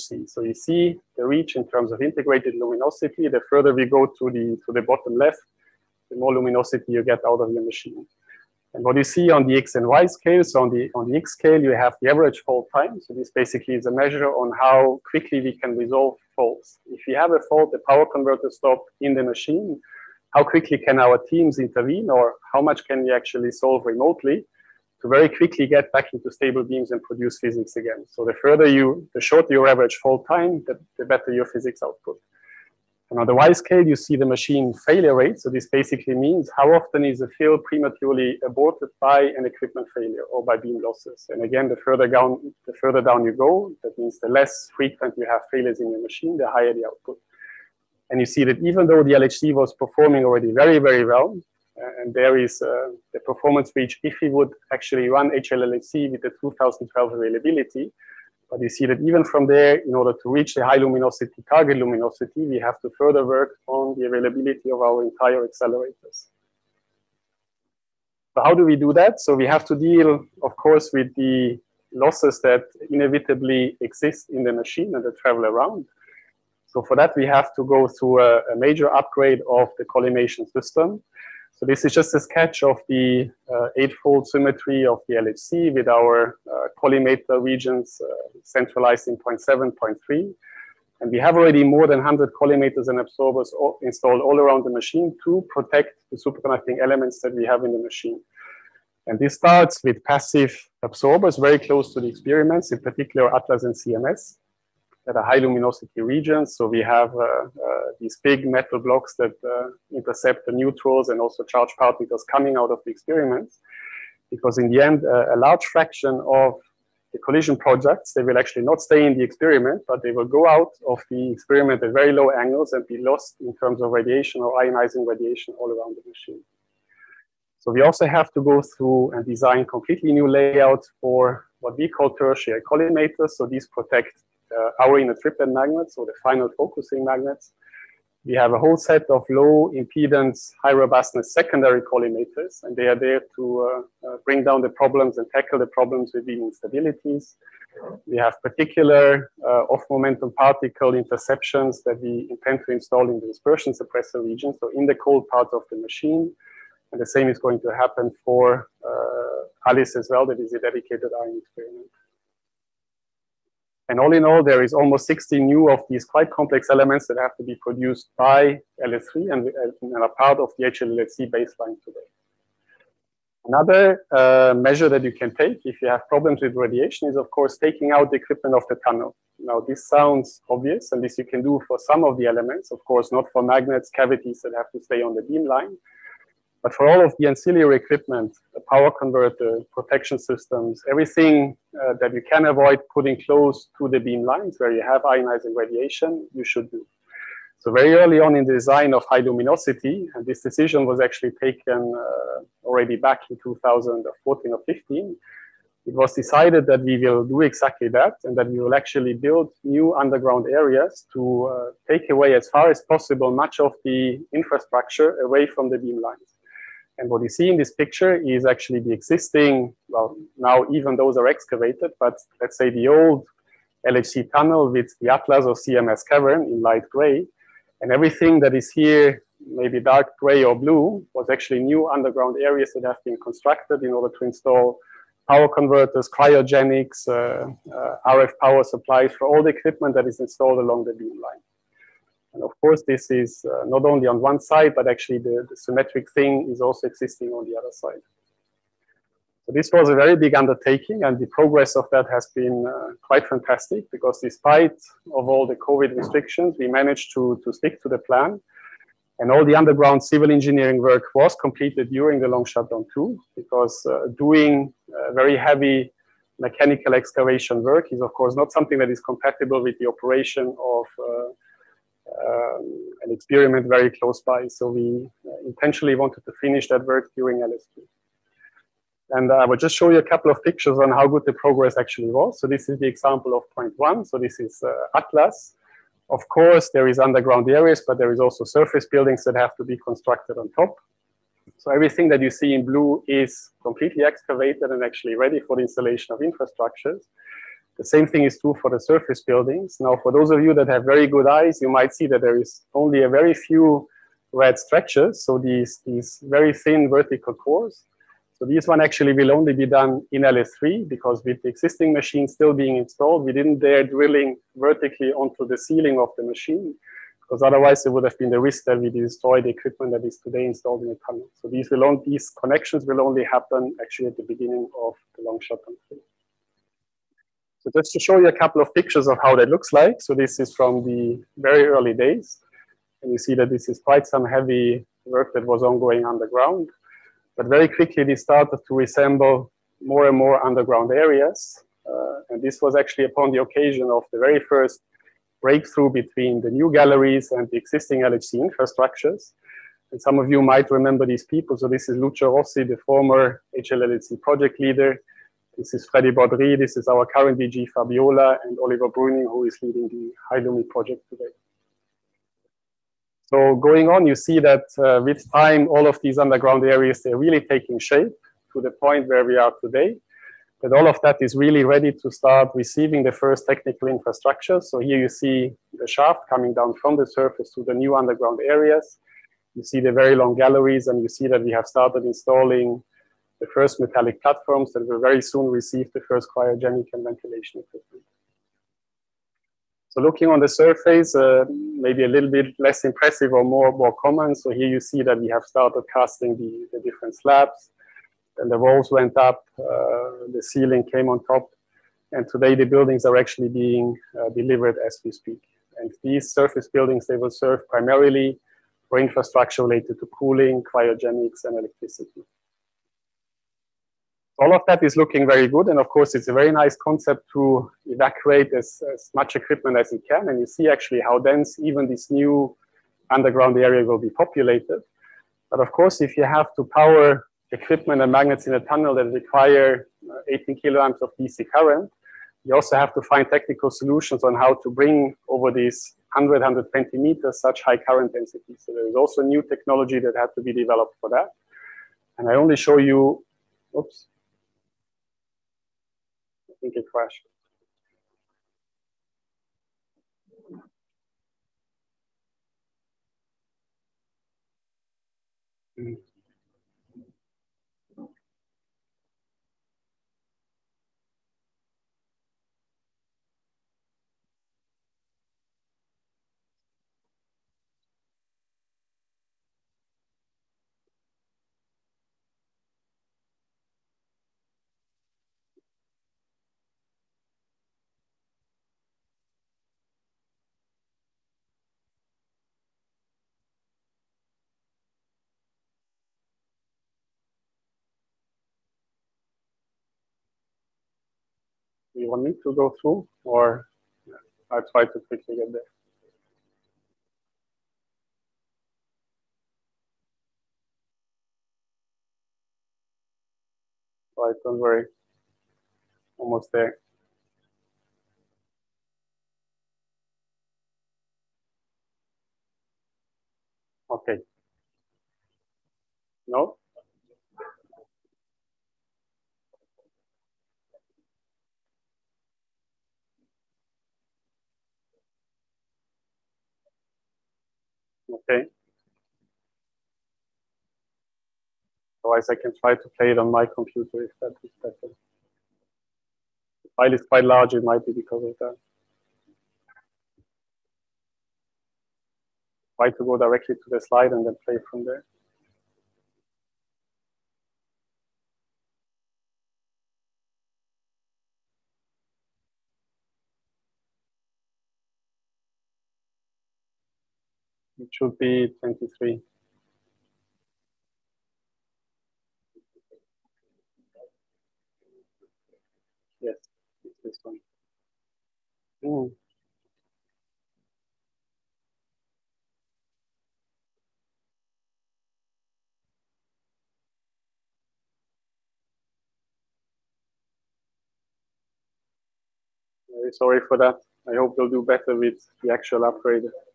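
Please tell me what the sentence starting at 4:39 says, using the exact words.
And I will just show you a couple of pictures on how good the progress actually was.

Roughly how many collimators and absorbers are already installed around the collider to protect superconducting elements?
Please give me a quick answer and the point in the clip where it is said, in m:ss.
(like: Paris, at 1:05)
more than 100, at 1:31.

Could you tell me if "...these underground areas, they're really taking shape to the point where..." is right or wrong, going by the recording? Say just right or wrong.
right.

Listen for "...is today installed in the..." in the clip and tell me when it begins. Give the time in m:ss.
5:20.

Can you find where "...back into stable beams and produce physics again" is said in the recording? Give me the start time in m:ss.
0:25.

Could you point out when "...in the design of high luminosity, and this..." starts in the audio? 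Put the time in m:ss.
3:18.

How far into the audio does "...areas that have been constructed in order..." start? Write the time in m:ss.
3:52.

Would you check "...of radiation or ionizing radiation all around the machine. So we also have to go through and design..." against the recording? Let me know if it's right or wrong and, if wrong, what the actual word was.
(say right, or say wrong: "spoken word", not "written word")
right.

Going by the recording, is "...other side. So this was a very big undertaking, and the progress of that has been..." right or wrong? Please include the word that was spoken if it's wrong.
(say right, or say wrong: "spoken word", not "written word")
right.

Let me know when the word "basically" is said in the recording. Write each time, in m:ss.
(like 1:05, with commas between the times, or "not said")
0:13, 0:35.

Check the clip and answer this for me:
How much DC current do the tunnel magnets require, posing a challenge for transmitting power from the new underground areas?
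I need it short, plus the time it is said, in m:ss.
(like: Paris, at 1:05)
18 kiloamps, at 7:10.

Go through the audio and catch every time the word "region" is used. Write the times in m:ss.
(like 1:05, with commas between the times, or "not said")
1:27, 1:45, 2:34.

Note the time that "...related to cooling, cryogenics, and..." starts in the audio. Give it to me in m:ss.
6:49.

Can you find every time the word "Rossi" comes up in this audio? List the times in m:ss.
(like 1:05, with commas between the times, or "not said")
5:52.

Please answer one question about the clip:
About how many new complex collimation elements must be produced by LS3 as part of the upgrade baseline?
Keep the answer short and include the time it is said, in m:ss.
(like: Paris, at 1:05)
almost 60, at 2:44.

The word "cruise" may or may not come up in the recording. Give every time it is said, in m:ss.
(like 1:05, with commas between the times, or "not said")
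not said.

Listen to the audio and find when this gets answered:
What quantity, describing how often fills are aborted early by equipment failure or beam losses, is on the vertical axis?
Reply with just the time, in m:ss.
0:34.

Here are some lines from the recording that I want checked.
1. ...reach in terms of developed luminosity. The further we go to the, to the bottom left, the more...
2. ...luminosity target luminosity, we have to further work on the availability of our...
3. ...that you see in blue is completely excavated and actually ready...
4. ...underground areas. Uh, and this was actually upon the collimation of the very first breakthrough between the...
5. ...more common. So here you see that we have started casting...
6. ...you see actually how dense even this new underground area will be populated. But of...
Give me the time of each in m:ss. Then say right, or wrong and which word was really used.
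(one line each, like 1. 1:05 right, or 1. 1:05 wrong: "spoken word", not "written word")
1. 0:01 wrong: "integrated", not "developed"
2. 1:00 right
3. 4:52 right
4. 5:40 wrong: "occasion", not "collimation"
5. 6:33 right
6. 7:00 right.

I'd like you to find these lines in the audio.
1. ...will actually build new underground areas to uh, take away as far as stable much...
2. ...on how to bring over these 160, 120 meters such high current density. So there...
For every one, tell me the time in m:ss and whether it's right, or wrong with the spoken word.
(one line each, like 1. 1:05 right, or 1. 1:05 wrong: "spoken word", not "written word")
1. 3:28 wrong: "possible", not "stable"
2. 7:14 wrong: "100", not "160".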